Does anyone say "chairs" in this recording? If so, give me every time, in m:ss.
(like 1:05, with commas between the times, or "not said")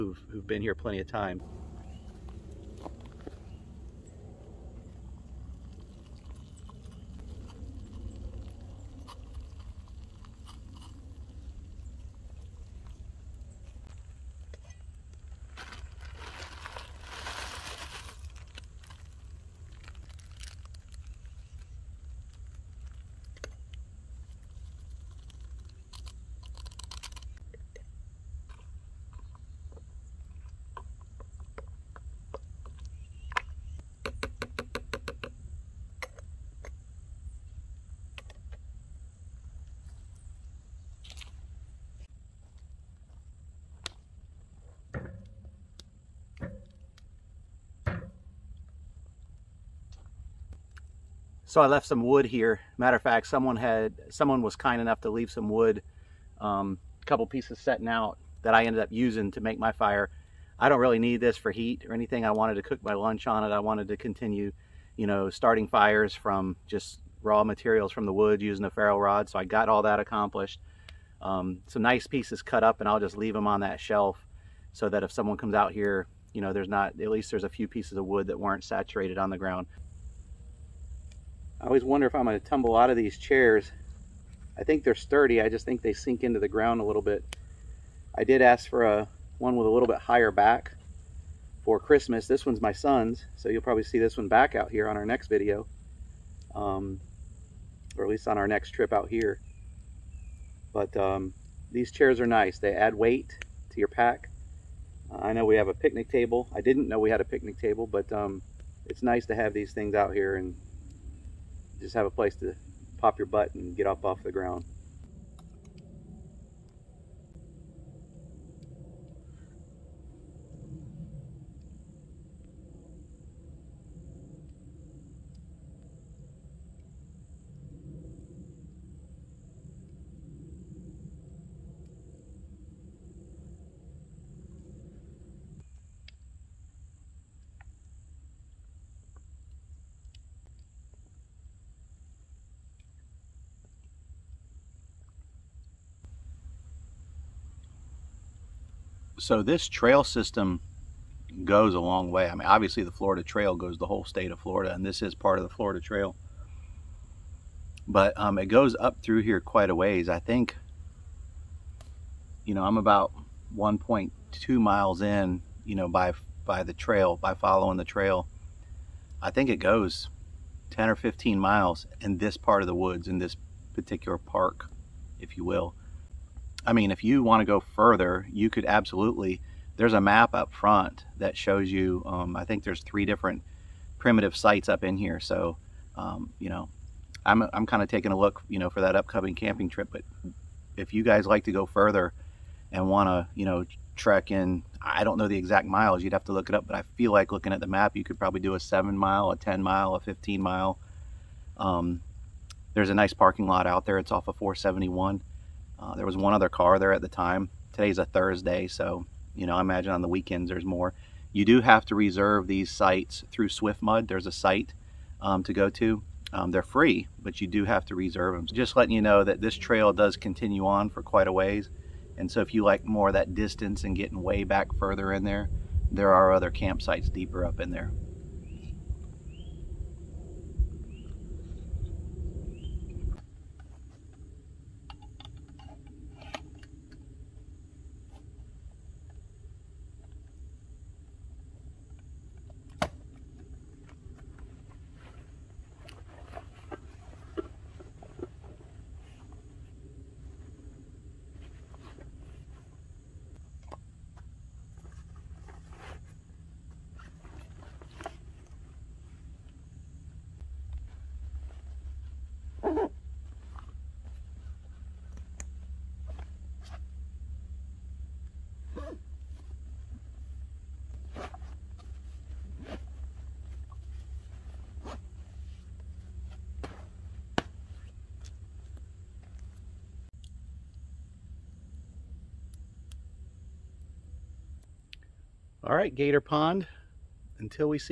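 1:23, 1:41.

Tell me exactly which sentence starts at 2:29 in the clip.
So this trail system goes a long way.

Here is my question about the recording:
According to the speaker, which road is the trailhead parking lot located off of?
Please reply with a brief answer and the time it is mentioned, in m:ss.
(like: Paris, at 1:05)
471, at 3:24.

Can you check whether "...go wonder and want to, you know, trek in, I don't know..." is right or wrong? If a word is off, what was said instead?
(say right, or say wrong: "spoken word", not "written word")
wrong: "further", not "wonder".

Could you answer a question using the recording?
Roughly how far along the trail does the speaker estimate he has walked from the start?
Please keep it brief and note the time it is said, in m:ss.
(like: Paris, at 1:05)
1.2 miles, at 2:43.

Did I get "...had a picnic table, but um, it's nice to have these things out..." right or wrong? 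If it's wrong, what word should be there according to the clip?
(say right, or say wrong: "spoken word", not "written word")
right.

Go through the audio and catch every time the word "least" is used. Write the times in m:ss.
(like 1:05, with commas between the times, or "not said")
1:17, 1:38.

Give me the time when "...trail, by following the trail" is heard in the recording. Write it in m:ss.
2:46.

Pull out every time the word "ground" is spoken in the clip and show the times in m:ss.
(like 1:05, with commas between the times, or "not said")
1:19, 1:26, 1:54.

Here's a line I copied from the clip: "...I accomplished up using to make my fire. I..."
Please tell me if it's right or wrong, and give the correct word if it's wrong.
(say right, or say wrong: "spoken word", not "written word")
wrong: "ended", not "accomplished".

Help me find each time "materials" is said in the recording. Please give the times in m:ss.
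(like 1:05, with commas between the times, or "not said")
1:07.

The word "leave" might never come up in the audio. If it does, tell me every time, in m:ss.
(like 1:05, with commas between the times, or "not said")
0:55, 1:13.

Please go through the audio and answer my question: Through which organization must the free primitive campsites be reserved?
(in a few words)
SwiftMud.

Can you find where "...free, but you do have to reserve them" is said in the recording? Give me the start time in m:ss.
3:36.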